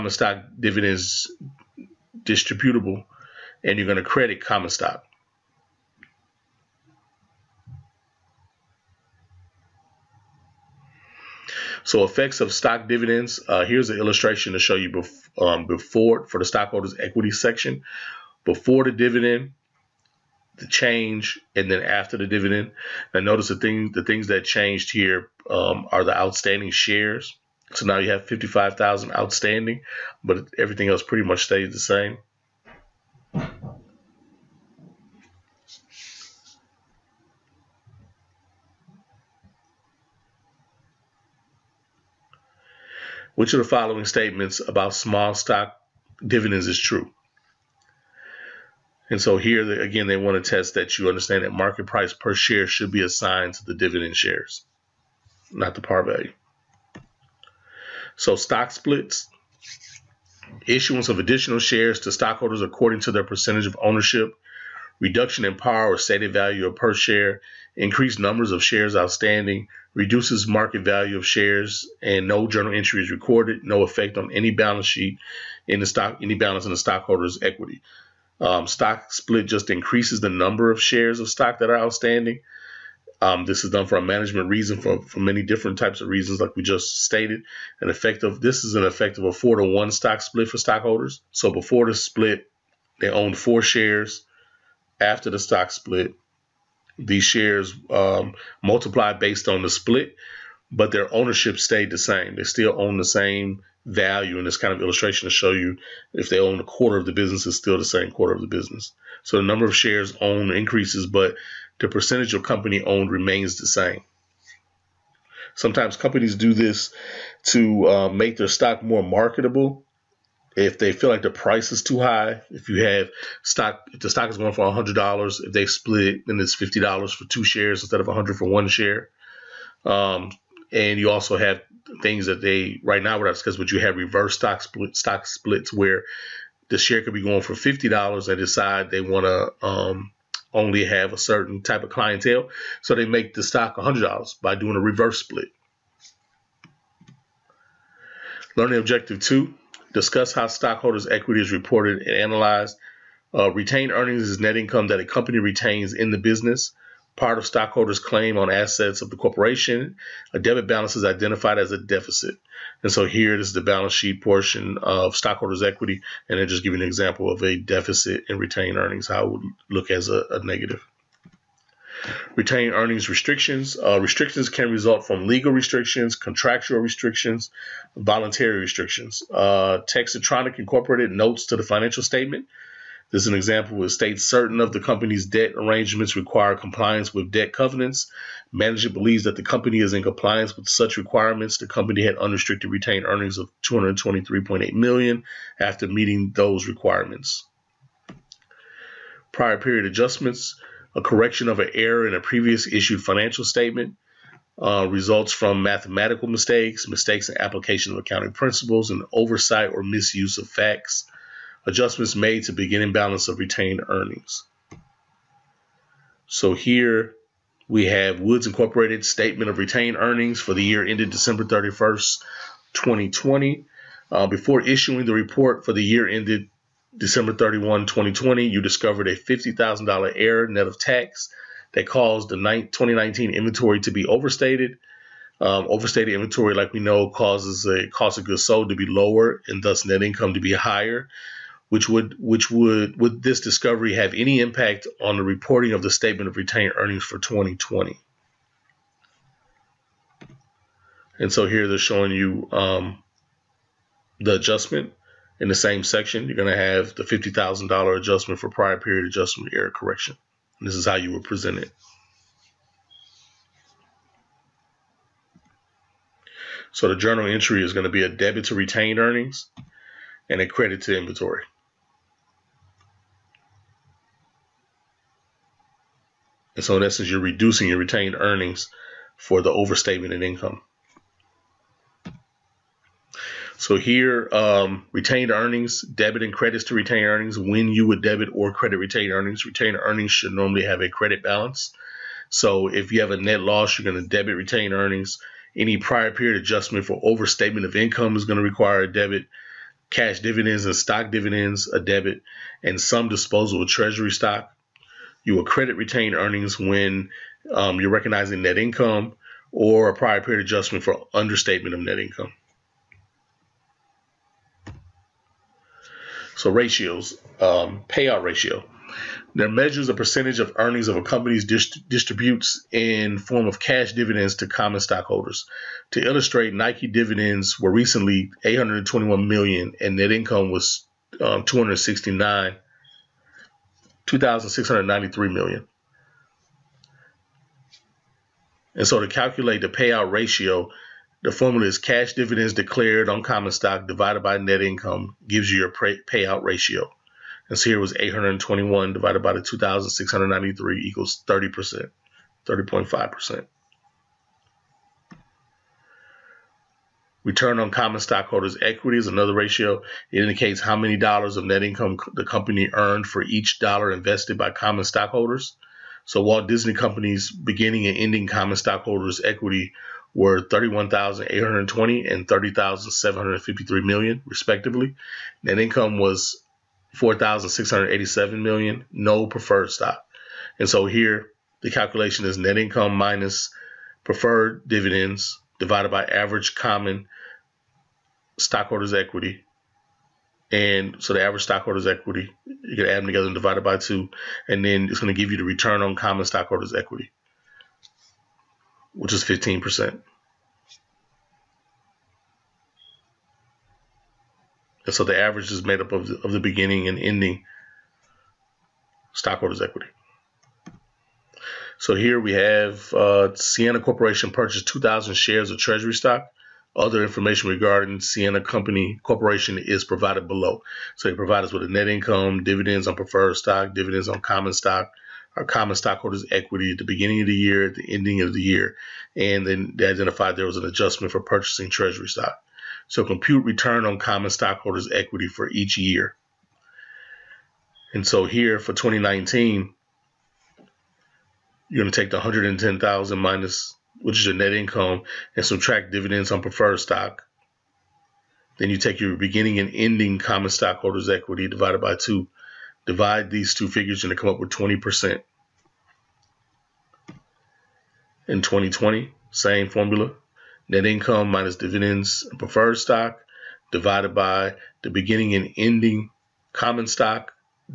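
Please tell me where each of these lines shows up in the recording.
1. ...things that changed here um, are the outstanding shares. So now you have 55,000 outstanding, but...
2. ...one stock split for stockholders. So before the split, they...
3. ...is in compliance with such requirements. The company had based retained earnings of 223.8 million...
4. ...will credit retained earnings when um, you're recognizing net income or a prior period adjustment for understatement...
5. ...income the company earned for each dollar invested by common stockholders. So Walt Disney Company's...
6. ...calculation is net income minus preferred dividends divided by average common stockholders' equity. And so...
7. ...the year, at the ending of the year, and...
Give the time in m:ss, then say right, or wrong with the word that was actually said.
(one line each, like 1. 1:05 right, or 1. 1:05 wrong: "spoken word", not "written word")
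1. 0:24 right
2. 1:29 right
3. 3:09 wrong: "unrestricted", not "based"
4. 5:05 right
5. 6:01 right
6. 6:21 right
7. 7:07 right.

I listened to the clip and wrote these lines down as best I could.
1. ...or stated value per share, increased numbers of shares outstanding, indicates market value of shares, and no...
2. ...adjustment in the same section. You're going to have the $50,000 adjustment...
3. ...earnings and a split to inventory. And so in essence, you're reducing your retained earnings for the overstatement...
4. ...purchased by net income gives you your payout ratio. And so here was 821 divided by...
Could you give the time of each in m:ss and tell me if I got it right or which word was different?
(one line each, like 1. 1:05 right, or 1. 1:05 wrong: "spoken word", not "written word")
1. 1:05 wrong: "reduces", not "indicates"
2. 4:14 right
3. 4:28 wrong: "credit", not "split"
4. 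5:43 wrong: "divided", not "purchased".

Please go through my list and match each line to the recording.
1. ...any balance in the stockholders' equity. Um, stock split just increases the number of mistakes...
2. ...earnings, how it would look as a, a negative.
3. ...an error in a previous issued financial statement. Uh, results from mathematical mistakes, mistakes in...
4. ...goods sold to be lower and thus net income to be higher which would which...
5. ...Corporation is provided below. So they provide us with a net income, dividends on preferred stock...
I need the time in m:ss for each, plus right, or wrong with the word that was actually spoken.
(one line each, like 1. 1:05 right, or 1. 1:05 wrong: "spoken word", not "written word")
1. 1:16 wrong: "shares", not "mistakes"
2. 2:48 right
3. 3:21 right
4. 3:58 right
5. 6:59 right.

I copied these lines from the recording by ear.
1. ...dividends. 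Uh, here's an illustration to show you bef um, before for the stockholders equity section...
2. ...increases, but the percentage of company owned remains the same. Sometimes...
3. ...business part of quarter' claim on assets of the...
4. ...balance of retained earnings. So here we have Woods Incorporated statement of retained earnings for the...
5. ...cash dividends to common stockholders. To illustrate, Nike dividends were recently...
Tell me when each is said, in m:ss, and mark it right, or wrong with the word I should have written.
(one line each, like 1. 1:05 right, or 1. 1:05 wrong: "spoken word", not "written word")
1. 0:12 right
2. 1:50 right
3. 2:36 wrong: "stockholders", not "quarter"
4. 3:32 right
5. 5:23 right.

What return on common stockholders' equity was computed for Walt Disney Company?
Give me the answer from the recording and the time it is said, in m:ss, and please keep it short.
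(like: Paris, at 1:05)
15%, at 6:39.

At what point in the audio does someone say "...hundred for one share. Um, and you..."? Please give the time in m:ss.
2:08.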